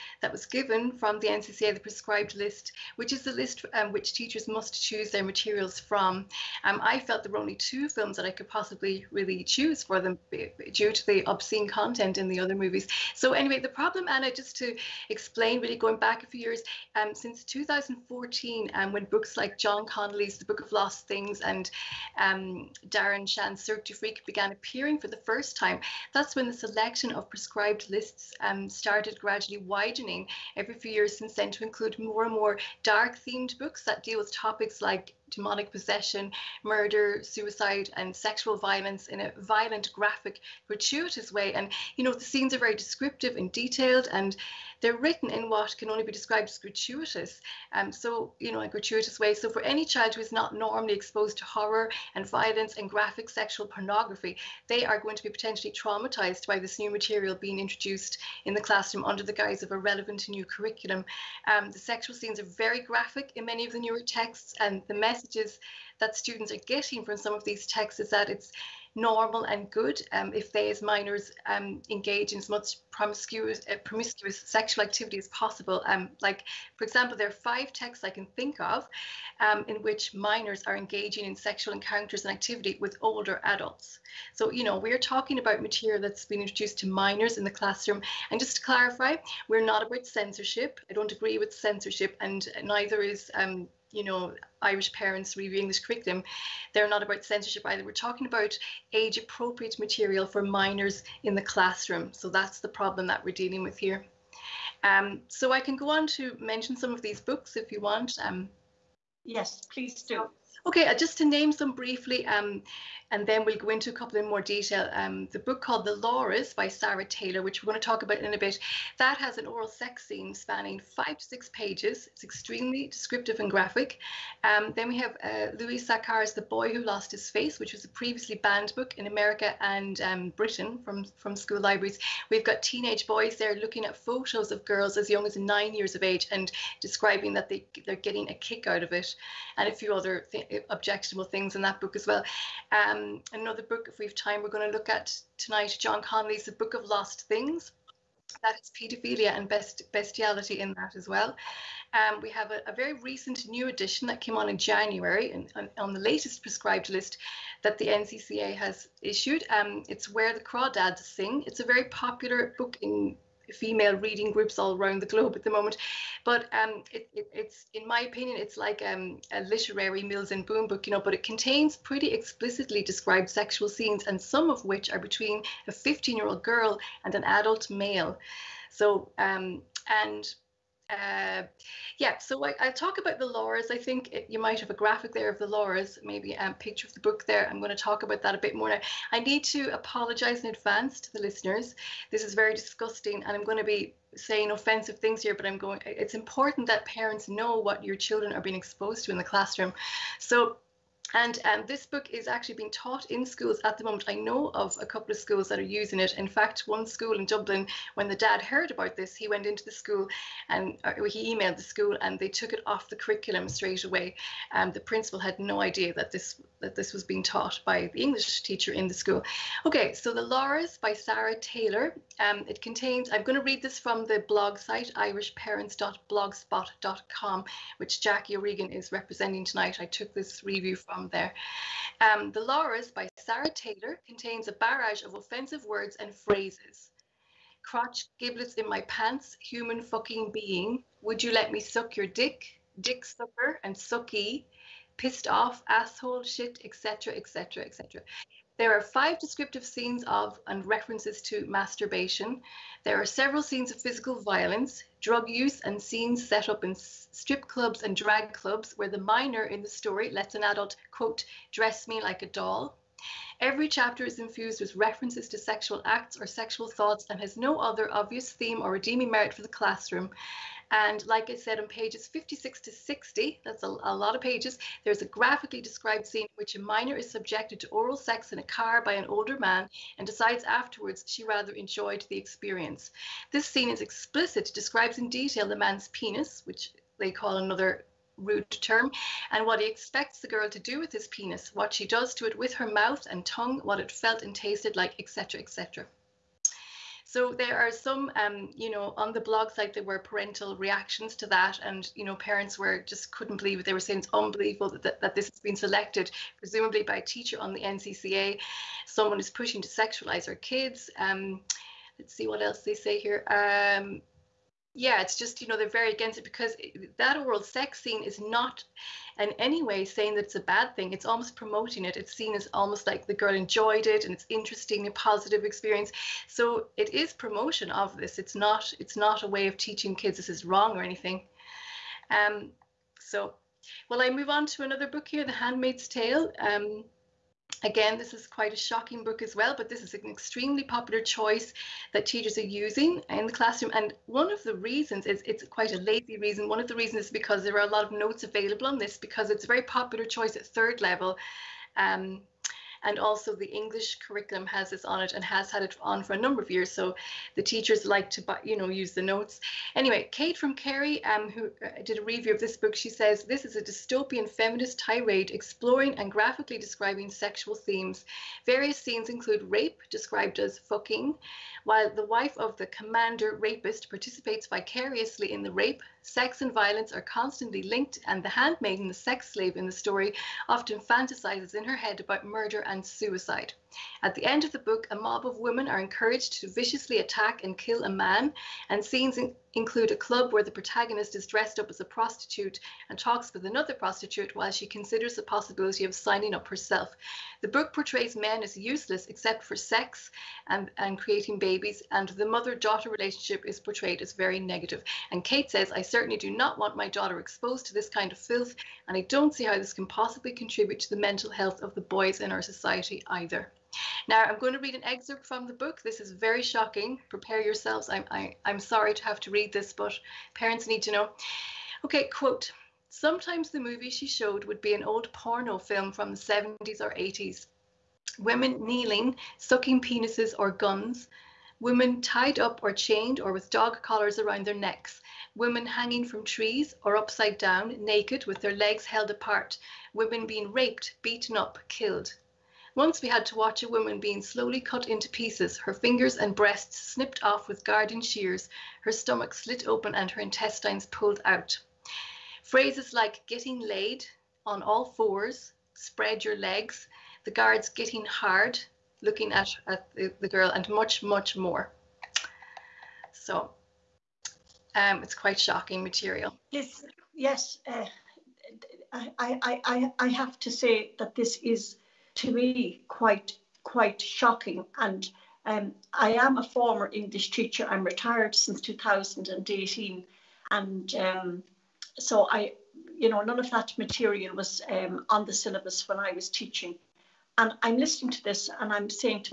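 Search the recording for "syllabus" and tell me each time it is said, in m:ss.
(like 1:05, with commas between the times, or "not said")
8:05.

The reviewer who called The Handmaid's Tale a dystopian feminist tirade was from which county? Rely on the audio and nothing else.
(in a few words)
Kerry.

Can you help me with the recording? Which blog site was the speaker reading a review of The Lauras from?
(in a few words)
irishparents.blogspot.com.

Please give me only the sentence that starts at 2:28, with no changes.
That is paedophilia and best, bestiality in that as well.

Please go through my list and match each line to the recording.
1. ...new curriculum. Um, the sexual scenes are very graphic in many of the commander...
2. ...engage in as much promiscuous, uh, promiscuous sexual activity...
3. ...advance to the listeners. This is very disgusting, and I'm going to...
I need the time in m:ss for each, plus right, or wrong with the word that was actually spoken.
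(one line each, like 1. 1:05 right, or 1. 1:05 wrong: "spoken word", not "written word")
1. 1:00 wrong: "newer", not "commander"
2. 1:11 right
3. 3:10 right.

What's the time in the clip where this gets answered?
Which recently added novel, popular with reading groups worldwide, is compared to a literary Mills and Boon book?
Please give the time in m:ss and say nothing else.
2:40.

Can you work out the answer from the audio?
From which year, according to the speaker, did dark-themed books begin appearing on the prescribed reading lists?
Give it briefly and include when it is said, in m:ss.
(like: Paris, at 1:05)
2014, at 0:17.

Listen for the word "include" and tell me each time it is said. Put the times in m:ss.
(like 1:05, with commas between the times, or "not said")
0:31, 6:09, 6:29.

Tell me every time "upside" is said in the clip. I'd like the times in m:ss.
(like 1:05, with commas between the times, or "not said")
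7:16.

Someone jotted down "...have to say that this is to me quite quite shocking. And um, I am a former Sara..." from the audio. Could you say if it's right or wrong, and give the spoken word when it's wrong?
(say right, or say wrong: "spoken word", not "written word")
wrong: "English", not "Sara".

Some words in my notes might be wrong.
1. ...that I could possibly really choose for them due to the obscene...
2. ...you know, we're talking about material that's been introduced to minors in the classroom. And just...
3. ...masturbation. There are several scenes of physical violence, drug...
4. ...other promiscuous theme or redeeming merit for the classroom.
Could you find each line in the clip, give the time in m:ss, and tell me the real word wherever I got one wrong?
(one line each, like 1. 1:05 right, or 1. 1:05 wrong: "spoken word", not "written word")
1. 0:08 right
2. 1:24 right
3. 4:11 right
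4. 4:27 wrong: "obvious", not "promiscuous".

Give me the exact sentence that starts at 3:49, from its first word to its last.
I took this review from from there.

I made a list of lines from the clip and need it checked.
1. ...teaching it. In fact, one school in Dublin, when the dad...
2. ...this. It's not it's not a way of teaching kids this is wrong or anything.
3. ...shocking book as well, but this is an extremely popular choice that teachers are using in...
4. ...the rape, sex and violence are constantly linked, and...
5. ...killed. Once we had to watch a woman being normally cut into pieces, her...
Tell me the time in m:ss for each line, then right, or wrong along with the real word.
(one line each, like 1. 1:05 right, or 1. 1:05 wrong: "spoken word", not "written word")
1. 3:25 wrong: "using", not "teaching"
2. 5:27 right
3. 5:38 right
4. 6:15 right
5. 7:21 wrong: "slowly", not "normally".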